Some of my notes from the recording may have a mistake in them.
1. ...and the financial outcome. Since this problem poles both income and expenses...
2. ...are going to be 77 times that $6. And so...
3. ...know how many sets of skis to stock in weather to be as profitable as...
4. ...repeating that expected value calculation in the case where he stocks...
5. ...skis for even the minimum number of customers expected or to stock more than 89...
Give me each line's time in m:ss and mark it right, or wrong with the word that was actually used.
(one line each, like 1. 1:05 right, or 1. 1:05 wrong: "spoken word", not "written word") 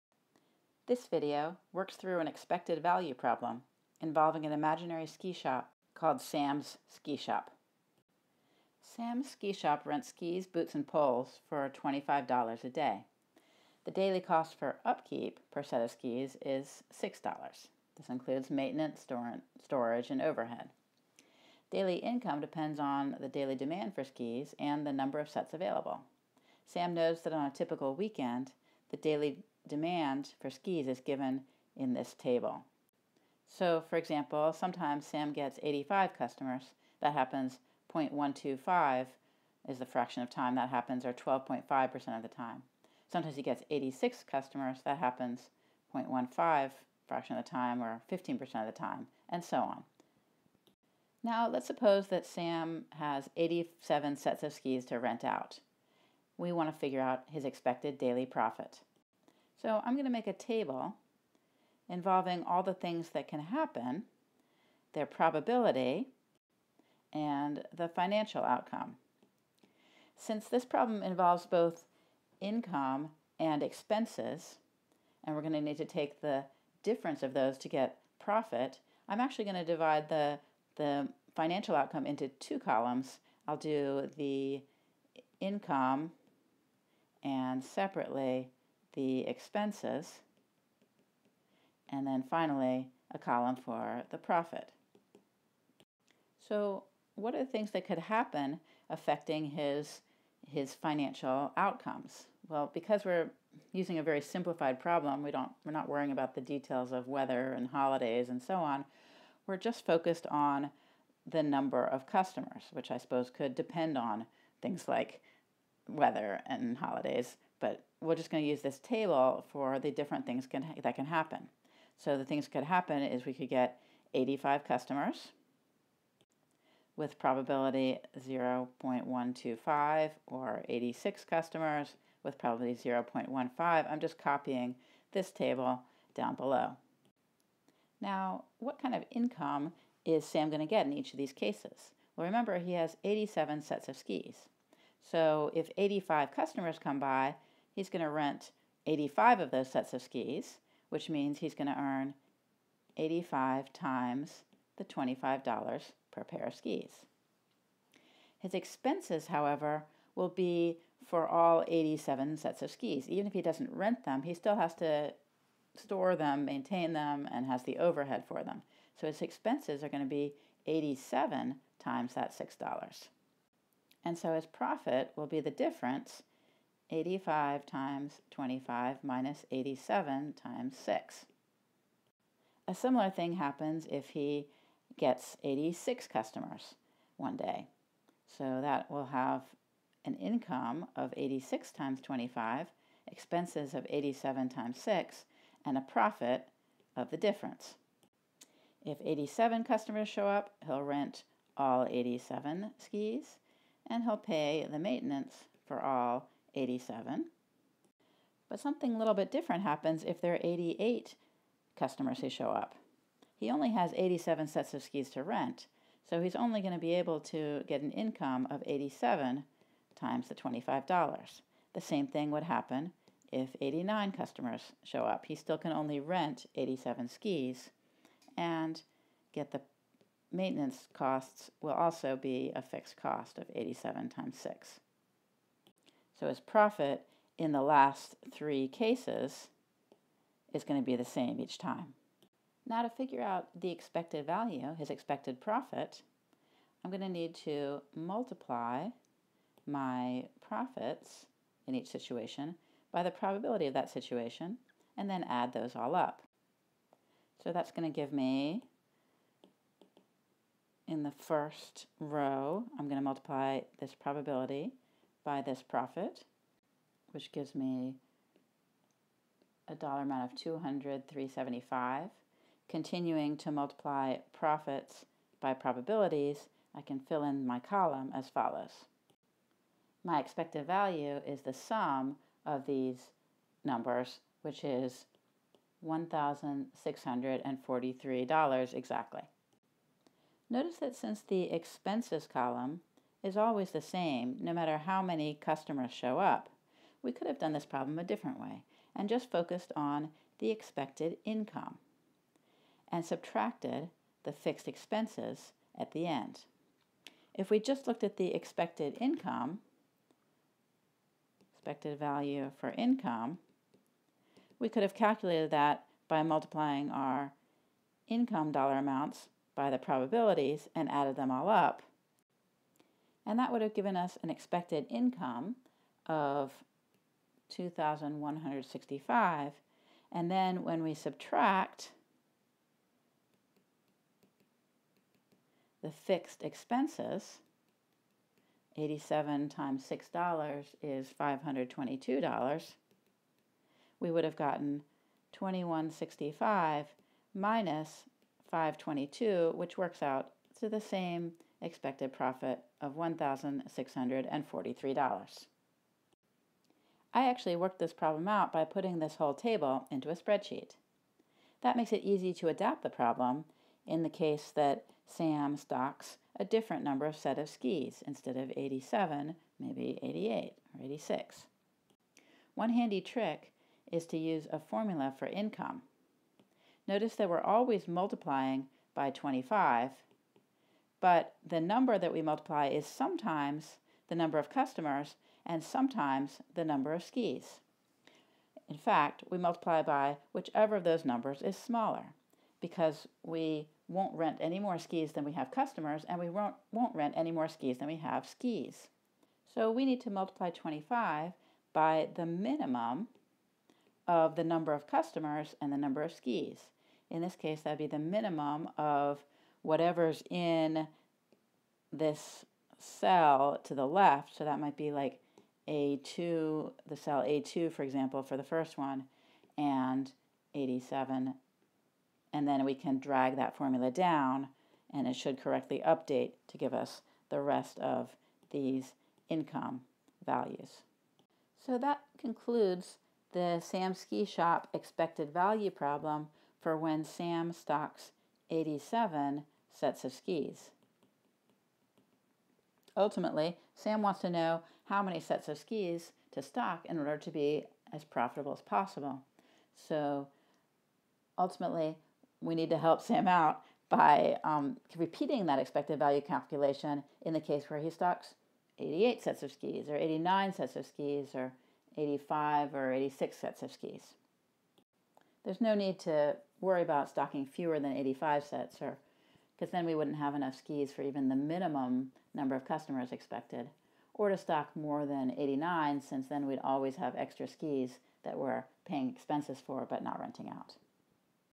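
1. 1:07 wrong: "involves", not "poles"
2. 2:49 wrong: "87", not "77"
3. 7:24 wrong: "order", not "weather"
4. 7:34 right
5. 7:50 right.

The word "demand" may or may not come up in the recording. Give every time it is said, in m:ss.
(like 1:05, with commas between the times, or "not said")
0:23, 0:29.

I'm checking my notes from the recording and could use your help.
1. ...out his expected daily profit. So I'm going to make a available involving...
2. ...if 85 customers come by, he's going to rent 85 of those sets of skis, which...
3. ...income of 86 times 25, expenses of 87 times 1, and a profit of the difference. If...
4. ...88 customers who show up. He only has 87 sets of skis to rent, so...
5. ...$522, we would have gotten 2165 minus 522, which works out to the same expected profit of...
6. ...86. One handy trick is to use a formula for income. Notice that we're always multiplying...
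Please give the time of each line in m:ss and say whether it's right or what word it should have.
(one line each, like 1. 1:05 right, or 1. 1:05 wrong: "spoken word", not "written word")
1. 0:57 wrong: "table", not "available"
2. 2:25 right
3. 3:10 wrong: "6", not "1"
4. 3:30 right
5. 5:41 right
6. 6:10 right.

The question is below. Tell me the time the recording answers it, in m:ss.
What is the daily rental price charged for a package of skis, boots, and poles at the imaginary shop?
0:11.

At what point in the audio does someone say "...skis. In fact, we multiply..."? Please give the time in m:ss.
6:27.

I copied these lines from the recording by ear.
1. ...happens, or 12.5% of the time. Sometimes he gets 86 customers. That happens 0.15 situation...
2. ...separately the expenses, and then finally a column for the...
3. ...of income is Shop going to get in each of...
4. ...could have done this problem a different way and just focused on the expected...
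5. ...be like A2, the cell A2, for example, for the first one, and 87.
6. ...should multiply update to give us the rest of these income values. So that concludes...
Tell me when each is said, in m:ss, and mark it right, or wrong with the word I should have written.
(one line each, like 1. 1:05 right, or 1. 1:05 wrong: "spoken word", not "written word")
1. 0:40 wrong: "fraction", not "situation"
2. 1:27 right
3. 2:18 wrong: "Sam", not "Shop"
4. 4:57 right
5. 6:54 right
6. 7:05 wrong: "correctly", not "multiply".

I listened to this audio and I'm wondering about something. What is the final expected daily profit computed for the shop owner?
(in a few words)
$1,643.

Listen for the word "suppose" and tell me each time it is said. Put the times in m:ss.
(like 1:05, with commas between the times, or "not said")
0:51, 1:52.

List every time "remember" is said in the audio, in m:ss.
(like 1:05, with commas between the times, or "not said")
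2:22.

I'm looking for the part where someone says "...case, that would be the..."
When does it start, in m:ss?
6:47.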